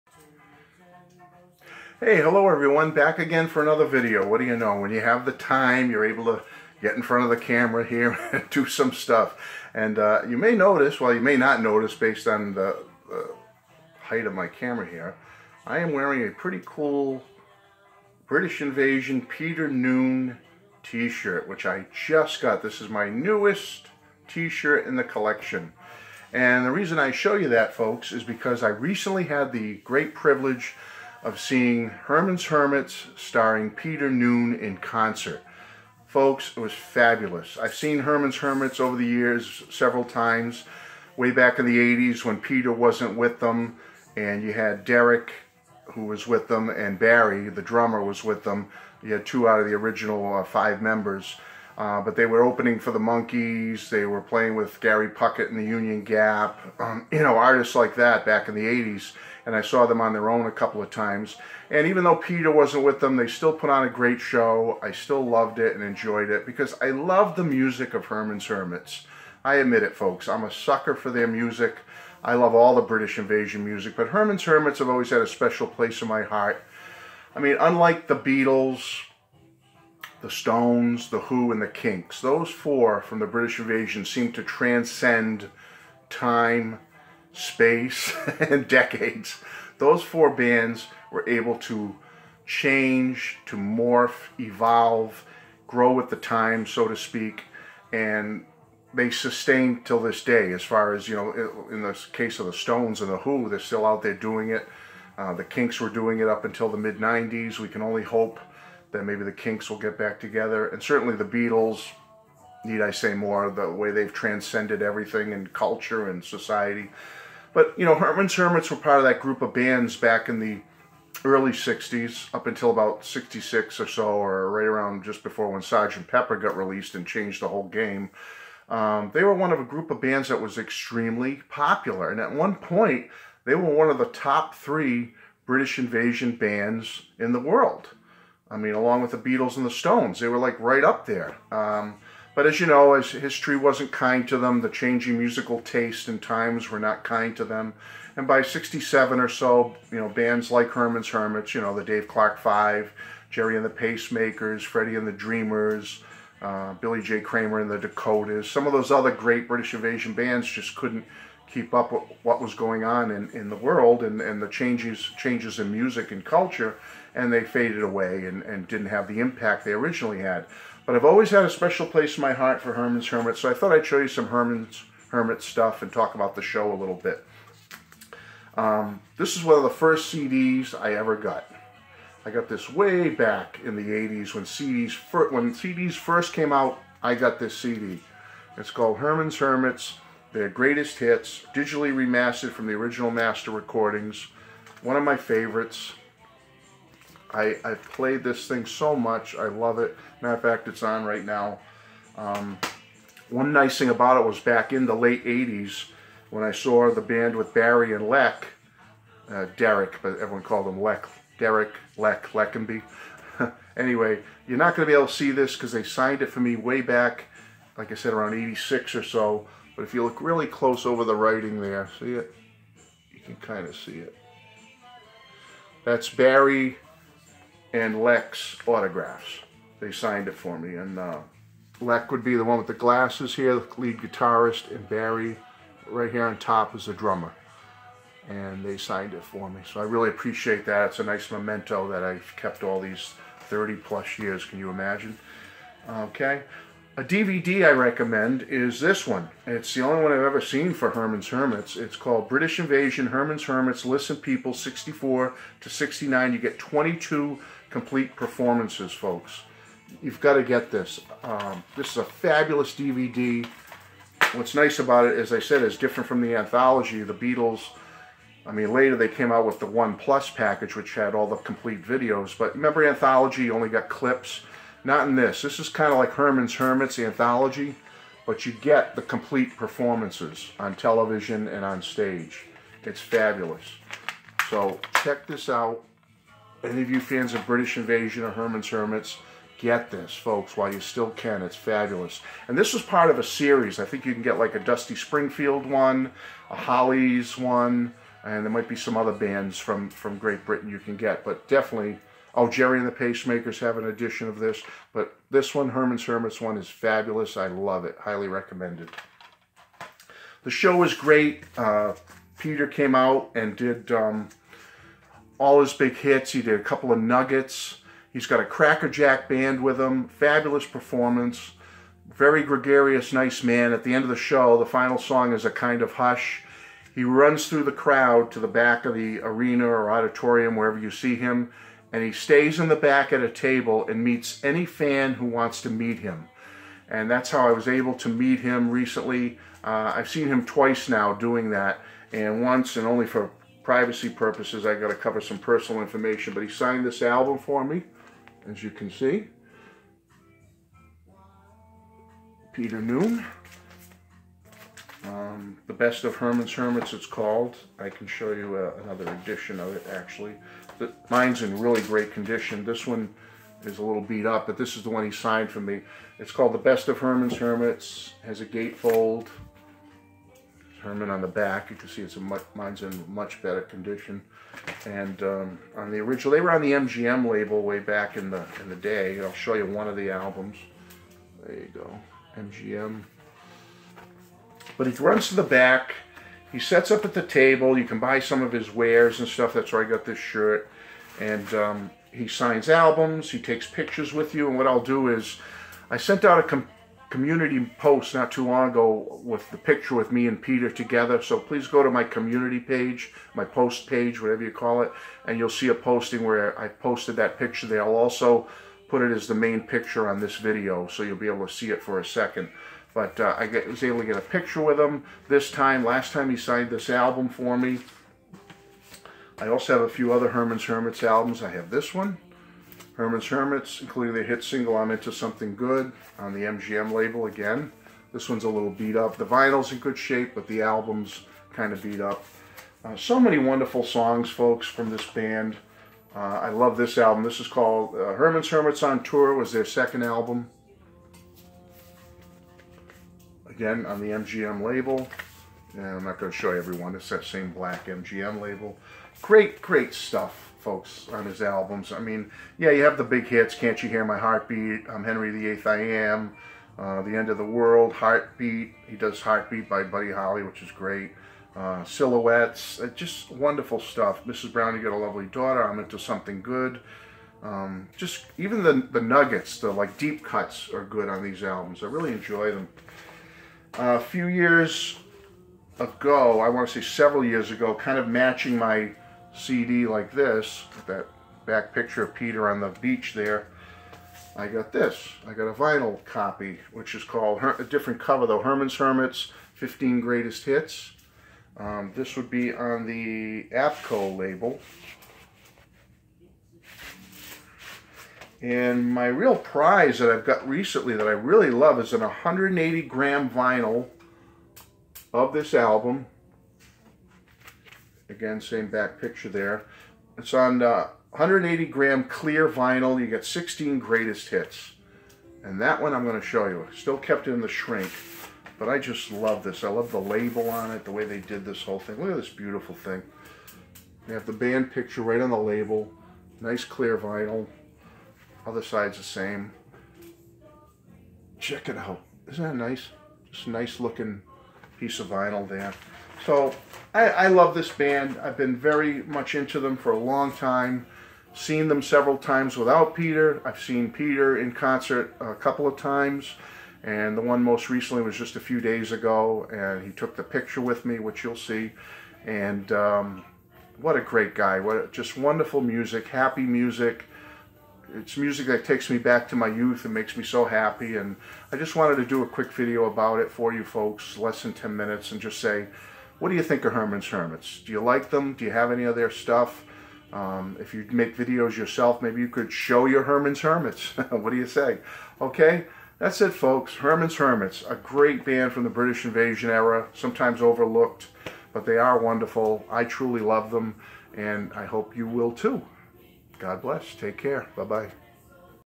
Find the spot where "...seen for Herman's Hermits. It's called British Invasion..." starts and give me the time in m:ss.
4:10.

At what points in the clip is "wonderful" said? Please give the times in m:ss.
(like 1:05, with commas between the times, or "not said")
7:13, 7:43, 9:15, 9:41.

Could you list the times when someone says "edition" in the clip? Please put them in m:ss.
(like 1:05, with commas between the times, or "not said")
5:03, 5:59.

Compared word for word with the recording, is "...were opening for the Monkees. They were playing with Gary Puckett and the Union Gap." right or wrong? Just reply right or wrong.
right.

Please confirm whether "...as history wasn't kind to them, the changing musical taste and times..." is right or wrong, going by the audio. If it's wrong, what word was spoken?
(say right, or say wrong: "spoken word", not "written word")
right.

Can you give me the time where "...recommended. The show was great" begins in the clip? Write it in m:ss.
5:08.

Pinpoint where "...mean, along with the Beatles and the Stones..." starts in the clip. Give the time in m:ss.
2:18.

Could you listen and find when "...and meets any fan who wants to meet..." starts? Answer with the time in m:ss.
5:33.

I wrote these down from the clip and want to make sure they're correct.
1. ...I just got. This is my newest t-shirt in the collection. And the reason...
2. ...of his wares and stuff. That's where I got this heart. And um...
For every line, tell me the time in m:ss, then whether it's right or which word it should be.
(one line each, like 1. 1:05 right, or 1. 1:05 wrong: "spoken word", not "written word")
1. 0:21 right
2. 6:28 wrong: "shirt", not "heart".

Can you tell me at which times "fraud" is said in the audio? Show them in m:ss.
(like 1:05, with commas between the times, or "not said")
not said.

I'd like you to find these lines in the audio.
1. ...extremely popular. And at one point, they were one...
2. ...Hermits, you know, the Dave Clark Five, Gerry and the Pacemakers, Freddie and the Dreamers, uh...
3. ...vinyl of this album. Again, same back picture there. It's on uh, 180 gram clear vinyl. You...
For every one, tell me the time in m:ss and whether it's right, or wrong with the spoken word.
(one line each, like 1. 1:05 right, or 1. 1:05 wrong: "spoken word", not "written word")
1. 2:10 right
2. 2:31 right
3. 8:23 right.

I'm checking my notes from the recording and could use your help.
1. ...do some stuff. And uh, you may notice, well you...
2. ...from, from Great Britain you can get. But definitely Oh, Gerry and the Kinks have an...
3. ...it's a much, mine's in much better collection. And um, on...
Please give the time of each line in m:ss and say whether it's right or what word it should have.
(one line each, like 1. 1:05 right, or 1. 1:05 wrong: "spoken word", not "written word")
1. 0:08 right
2. 4:59 wrong: "Pacemakers", not "Kinks"
3. 6:12 wrong: "condition", not "collection".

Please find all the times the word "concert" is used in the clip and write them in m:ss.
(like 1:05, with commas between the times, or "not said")
0:34, 9:04.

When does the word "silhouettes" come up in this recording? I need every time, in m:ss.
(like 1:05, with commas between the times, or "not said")
7:41.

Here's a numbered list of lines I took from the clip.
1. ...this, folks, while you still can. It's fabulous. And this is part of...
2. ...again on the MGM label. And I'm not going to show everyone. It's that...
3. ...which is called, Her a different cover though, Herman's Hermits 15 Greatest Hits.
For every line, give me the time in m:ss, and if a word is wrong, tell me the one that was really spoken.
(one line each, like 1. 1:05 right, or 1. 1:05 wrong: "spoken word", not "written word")
1. 4:49 right
2. 7:23 right
3. 8:06 right.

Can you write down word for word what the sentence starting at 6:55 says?
Last time he signed this album for me.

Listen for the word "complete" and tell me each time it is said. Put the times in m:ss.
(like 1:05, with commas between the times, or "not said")
4:17, 4:31, 4:39.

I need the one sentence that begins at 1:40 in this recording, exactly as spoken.
As far as, you know, in the case of the Stones and the Who, they're still out there doing it.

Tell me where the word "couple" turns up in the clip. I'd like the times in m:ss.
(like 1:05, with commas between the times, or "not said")
1:00, 5:16, 9:05.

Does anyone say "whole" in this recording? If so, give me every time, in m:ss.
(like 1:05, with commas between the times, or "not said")
2:07, 8:41.